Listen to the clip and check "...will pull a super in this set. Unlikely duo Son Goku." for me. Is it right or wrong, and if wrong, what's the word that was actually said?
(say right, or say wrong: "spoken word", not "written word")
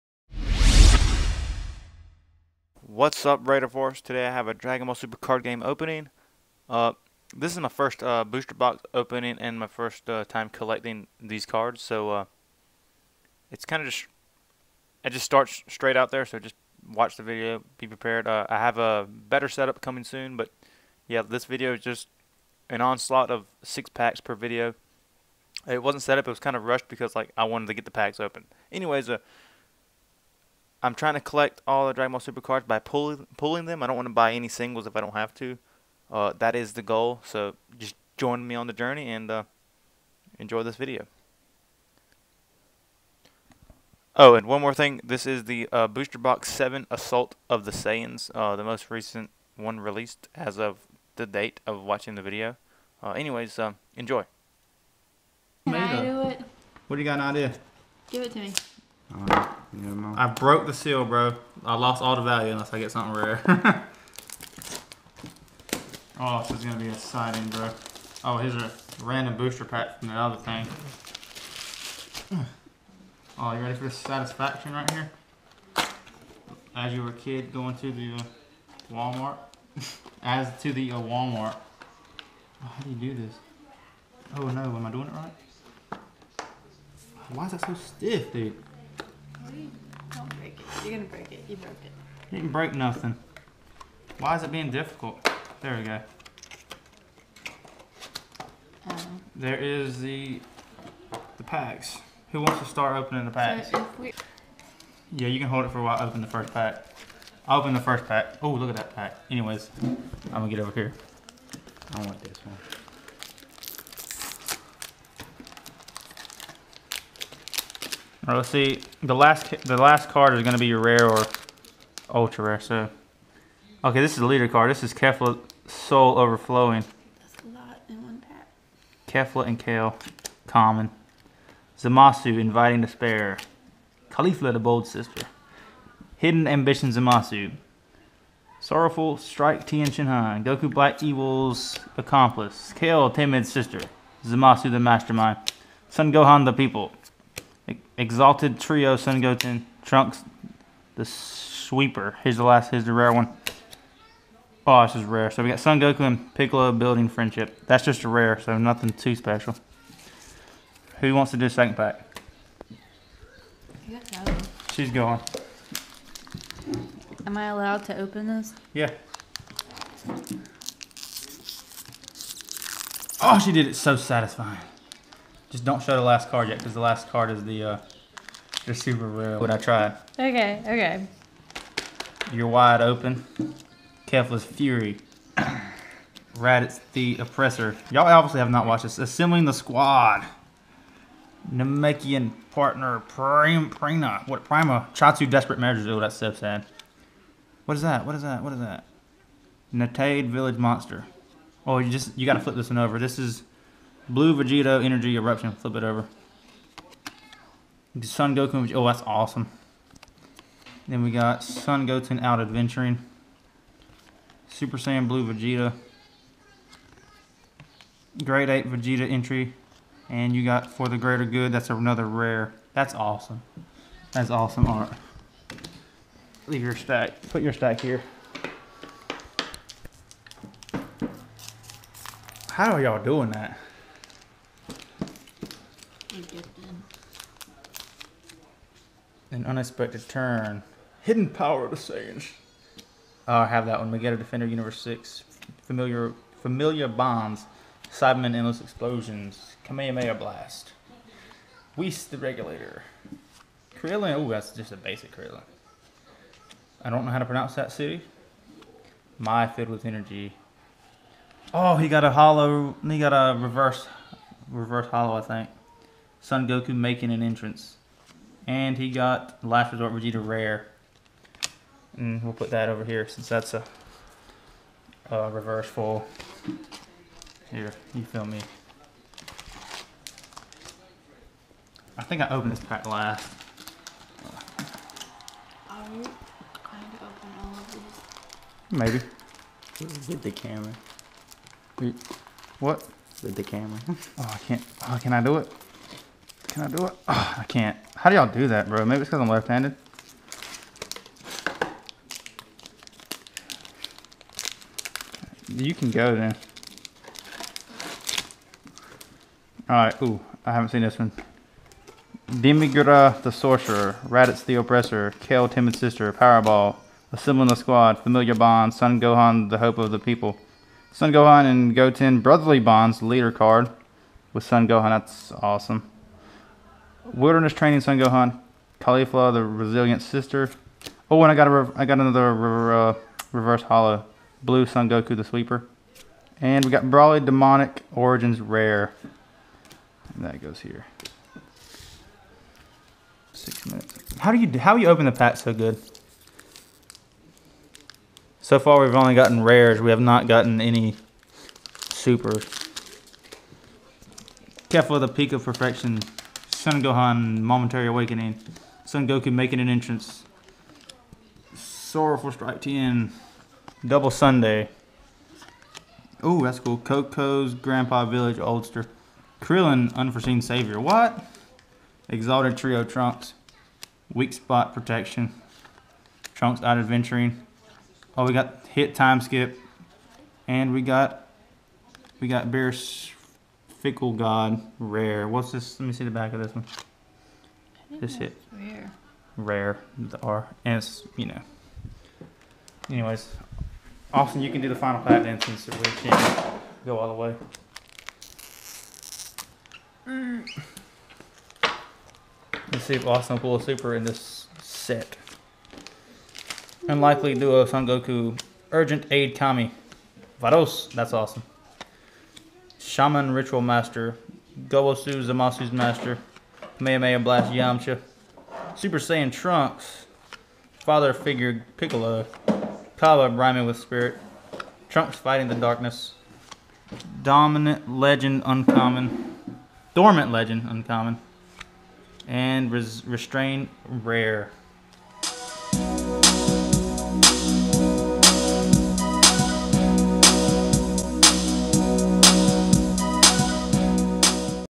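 right.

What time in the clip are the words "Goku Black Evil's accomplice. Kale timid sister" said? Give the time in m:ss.
2:20.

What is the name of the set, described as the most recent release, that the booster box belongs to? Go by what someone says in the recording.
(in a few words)
Assault of the Saiyans.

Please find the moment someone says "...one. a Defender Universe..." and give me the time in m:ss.
4:03.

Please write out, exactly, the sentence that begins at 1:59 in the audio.
The last the last card is going to be your rare or ultra rare.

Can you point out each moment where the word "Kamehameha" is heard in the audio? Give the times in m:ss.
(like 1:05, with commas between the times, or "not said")
4:09, 6:56.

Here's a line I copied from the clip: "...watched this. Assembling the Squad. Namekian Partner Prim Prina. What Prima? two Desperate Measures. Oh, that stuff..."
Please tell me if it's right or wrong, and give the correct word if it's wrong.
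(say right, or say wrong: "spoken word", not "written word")
right.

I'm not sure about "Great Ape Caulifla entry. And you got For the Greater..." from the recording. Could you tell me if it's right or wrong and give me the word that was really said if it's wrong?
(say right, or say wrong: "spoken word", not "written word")
wrong: "Vegeta", not "Caulifla".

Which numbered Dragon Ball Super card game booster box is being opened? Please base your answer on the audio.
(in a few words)
Booster Box 7.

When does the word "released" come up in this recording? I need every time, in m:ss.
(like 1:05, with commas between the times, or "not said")
0:49.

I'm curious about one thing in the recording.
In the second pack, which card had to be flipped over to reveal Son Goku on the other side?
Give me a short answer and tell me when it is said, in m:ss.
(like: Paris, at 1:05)
Blue Vegito Energy Eruption, at 3:24.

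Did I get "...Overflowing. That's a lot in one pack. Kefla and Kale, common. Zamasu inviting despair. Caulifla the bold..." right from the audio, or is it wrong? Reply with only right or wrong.
right.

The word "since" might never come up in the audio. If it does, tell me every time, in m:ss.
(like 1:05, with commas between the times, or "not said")
4:33, 6:35.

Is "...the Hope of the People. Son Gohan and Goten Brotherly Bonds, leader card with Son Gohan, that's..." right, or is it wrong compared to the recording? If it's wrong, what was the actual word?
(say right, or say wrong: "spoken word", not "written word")
right.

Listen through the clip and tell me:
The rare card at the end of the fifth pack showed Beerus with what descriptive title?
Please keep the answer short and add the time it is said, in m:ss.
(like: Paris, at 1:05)
Fickle God, at 6:23.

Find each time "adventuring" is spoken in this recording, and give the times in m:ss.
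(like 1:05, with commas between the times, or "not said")
3:32, 6:16.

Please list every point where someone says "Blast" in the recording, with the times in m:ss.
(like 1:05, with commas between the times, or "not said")
4:10, 6:57.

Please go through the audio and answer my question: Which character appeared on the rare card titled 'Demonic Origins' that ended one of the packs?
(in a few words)
Broly.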